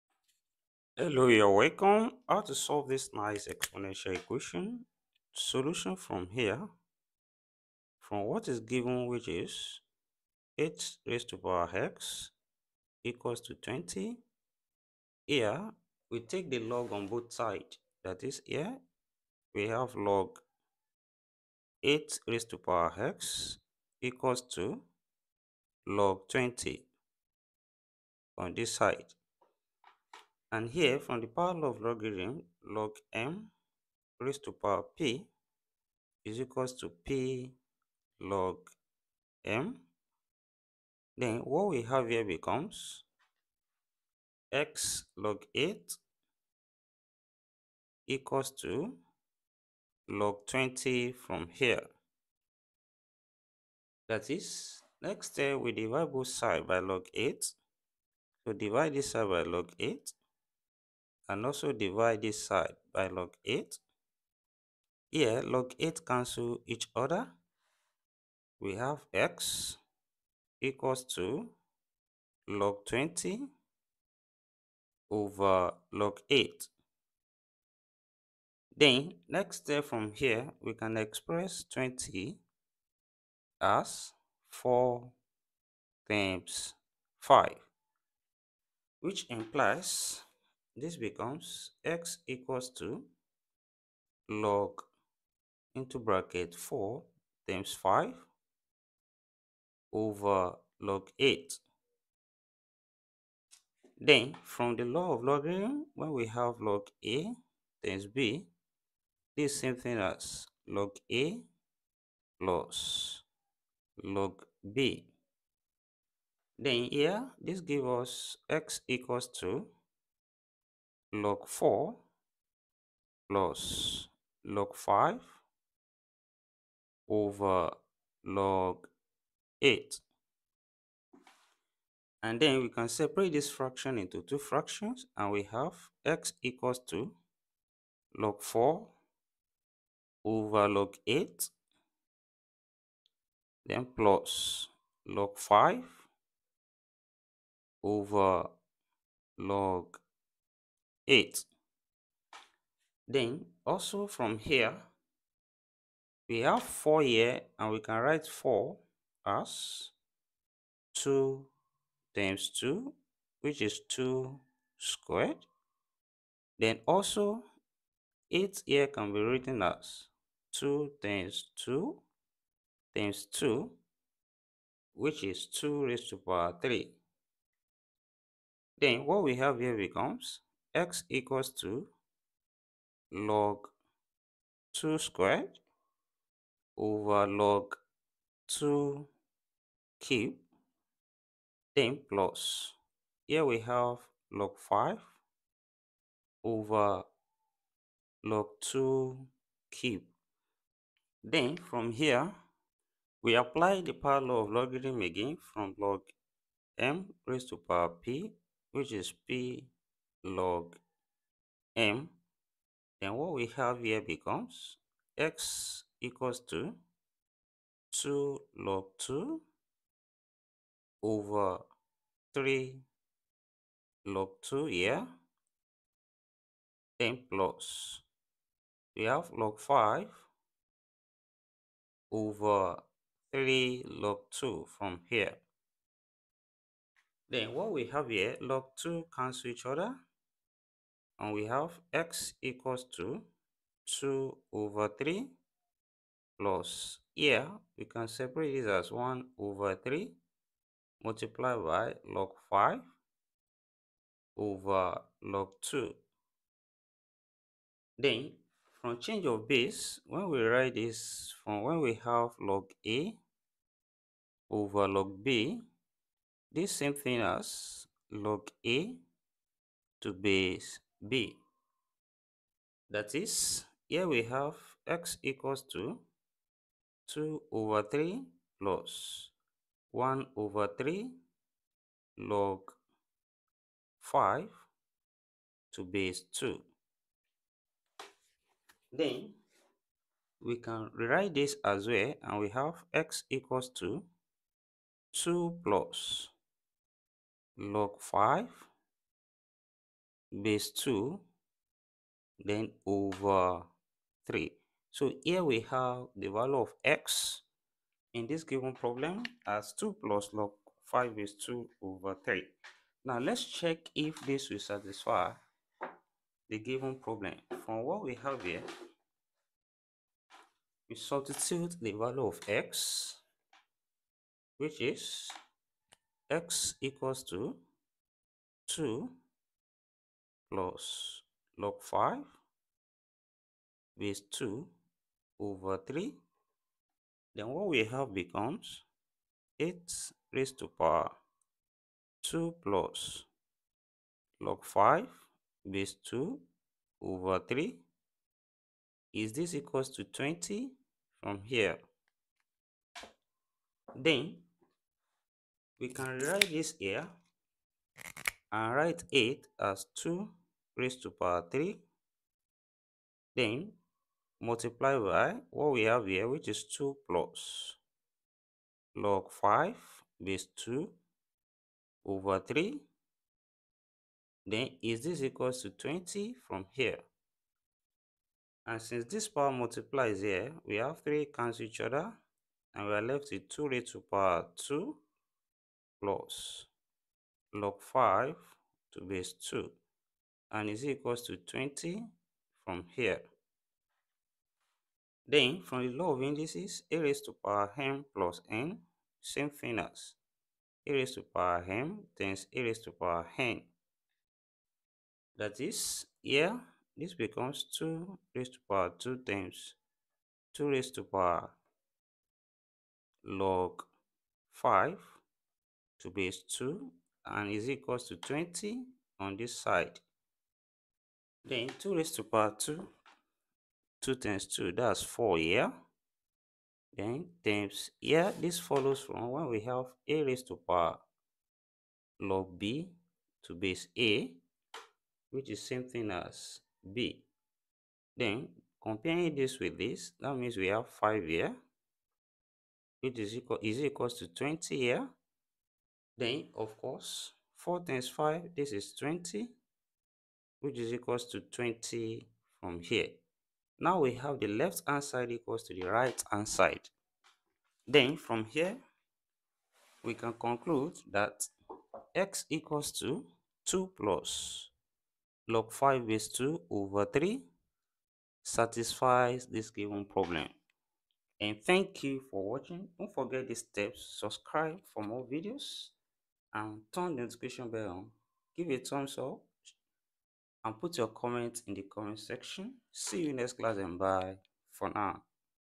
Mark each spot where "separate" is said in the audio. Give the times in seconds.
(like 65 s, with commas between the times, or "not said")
132 s, 248 s.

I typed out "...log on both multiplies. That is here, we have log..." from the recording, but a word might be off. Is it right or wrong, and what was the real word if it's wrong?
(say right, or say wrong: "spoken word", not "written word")
wrong: "sides", not "multiplies".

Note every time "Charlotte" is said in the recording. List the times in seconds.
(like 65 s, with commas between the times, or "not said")
not said.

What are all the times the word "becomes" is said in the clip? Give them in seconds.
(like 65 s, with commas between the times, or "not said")
42 s, 90 s, 179 s, 214 s, 338 s, 407 s.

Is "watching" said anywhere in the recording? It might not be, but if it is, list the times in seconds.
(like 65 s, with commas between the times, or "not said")
472 s.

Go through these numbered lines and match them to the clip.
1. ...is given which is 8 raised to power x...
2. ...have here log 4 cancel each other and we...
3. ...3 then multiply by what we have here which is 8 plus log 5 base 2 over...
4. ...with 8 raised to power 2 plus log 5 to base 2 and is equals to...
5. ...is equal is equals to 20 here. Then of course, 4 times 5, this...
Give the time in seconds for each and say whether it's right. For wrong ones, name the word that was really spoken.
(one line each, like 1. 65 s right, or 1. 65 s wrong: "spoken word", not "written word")
1. 8 s right
2. 237 s wrong: "2", not "4"
3. 361 s wrong: "2", not "8"
4. 383 s wrong: "2", not "8"
5. 443 s right.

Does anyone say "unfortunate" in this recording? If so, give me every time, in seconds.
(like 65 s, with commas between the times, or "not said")
not said.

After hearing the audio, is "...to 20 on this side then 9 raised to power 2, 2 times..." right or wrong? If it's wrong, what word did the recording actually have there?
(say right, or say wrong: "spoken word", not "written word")
wrong: "2", not "9".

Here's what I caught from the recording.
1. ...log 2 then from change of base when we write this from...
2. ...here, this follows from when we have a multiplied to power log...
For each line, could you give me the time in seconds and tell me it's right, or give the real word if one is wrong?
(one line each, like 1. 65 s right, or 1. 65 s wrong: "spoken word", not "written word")
1. 255 s right
2. 427 s wrong: "raised", not "multiplied".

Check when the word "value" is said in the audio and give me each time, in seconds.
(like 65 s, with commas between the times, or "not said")
306 s, 321 s.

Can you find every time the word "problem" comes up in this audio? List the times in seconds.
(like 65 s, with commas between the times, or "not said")
308 s, 316 s, 470 s.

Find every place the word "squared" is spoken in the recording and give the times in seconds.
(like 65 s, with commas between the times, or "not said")
164 s, 184 s.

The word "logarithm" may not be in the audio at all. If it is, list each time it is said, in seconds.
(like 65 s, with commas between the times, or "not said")
31 s, 105 s, 204 s.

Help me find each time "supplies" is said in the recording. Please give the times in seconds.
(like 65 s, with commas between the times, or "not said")
not said.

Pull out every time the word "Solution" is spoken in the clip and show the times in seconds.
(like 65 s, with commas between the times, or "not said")
5 s.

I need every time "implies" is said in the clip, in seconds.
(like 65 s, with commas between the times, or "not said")
89 s.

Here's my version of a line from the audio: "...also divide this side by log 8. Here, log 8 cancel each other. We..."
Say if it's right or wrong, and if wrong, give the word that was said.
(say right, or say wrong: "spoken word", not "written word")
right.